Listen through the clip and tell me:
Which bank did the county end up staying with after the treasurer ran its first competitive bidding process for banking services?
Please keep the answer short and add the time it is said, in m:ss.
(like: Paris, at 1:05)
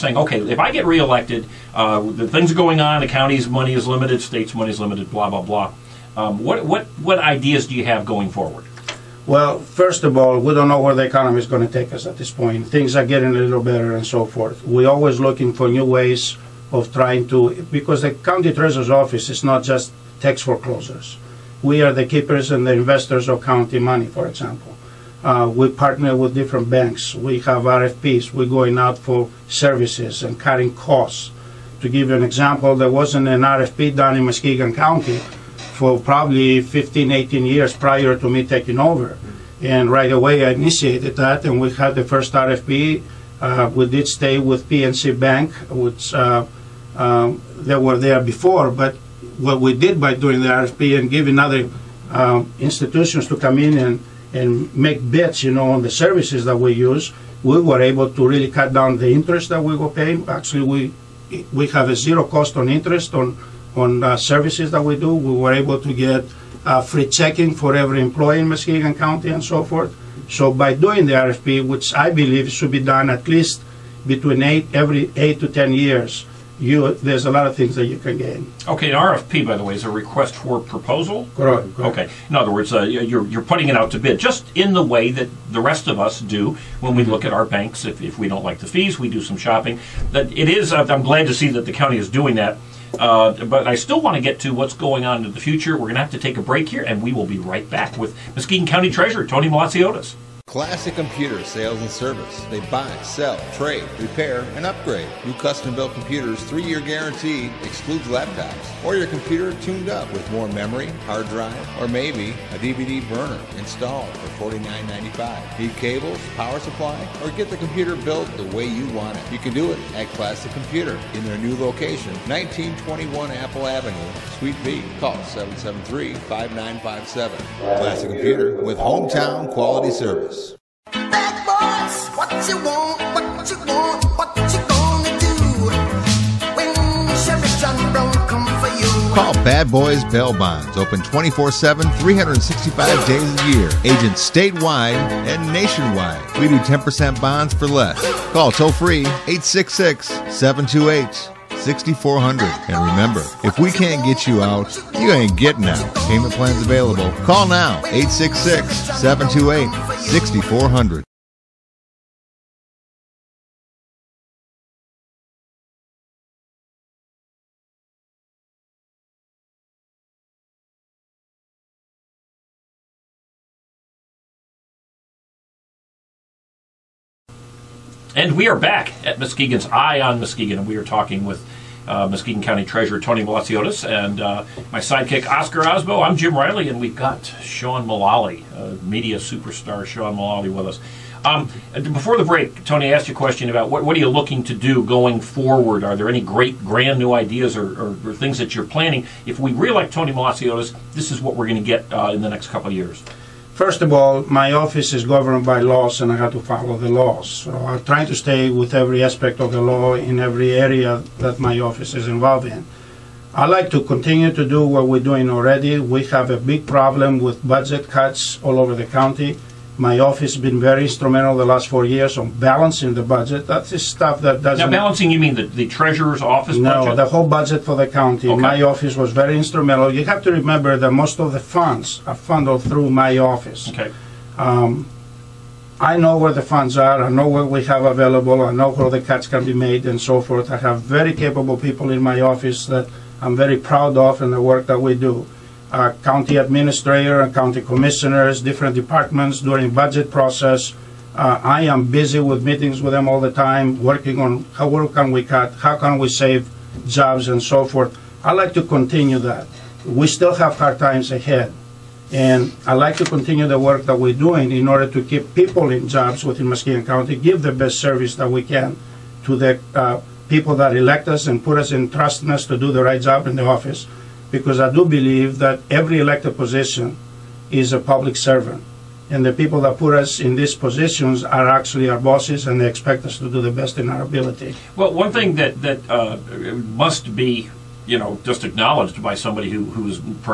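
PNC Bank, at 0:44.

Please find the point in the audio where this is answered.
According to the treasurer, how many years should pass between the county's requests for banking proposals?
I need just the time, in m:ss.
1:14.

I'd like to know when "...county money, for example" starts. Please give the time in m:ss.
0:23.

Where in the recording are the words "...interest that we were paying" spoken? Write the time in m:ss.
0:59.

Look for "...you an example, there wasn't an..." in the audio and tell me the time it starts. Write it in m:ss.
0:32.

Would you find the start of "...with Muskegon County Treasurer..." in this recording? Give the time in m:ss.
1:37.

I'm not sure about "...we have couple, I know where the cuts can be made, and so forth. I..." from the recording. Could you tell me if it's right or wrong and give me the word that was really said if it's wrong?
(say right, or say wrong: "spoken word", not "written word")
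wrong: "available", not "couple".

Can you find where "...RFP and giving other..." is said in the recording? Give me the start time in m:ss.
0:50.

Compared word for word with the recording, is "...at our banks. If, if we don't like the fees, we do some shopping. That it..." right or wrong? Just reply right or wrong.
right.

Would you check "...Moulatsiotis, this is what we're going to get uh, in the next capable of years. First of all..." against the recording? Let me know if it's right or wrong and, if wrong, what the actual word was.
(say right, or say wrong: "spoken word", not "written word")
wrong: "couple", not "capable".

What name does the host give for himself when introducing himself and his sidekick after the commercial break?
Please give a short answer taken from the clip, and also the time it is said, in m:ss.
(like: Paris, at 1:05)
Jim Riley, at 3:06.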